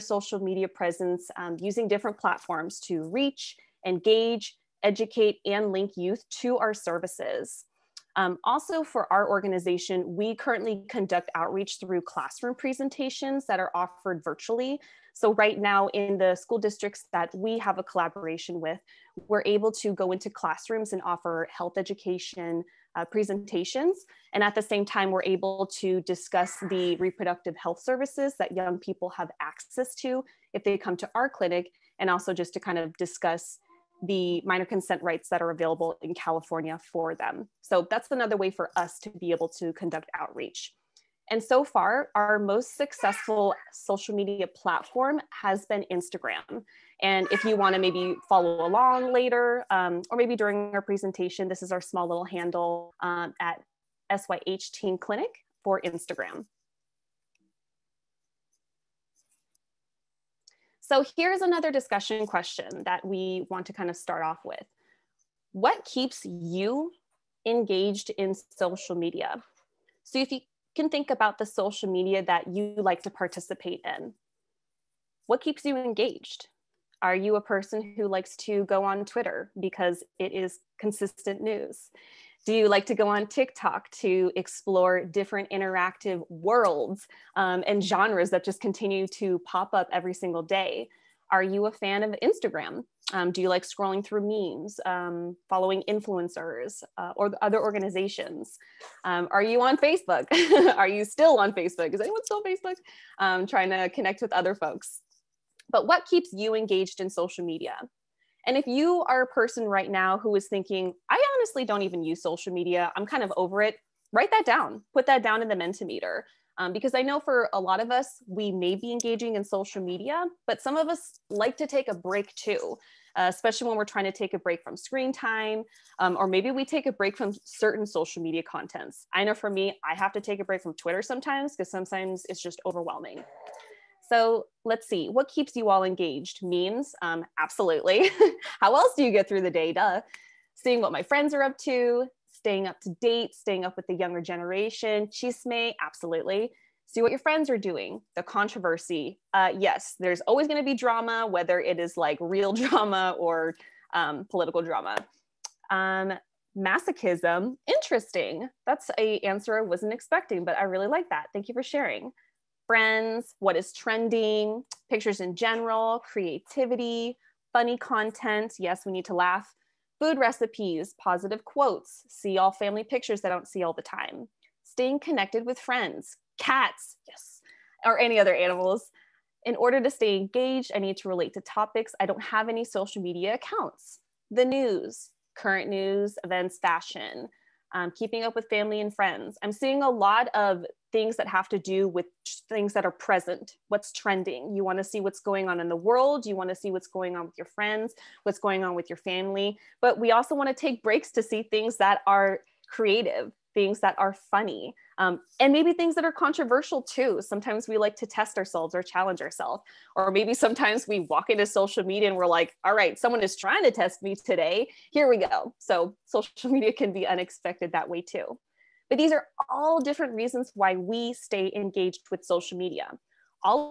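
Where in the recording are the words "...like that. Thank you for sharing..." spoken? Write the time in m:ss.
2:40.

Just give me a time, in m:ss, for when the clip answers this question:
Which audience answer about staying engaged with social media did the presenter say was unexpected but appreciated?
2:36.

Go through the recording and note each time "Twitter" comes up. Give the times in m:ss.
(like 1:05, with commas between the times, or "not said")
1:19, 2:10.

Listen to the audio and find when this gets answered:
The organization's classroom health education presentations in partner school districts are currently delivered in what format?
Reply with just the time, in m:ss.
0:14.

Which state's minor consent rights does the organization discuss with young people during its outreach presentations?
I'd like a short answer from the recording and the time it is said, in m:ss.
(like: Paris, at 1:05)
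California, at 0:36.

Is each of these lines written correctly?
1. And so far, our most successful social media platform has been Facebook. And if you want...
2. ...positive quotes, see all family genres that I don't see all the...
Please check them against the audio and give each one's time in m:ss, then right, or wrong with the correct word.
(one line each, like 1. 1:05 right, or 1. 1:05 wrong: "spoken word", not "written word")
1. 0:41 wrong: "Instagram", not "Facebook"
2. 2:51 wrong: "pictures", not "genres".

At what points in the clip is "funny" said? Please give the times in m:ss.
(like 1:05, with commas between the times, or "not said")
2:47, 3:24.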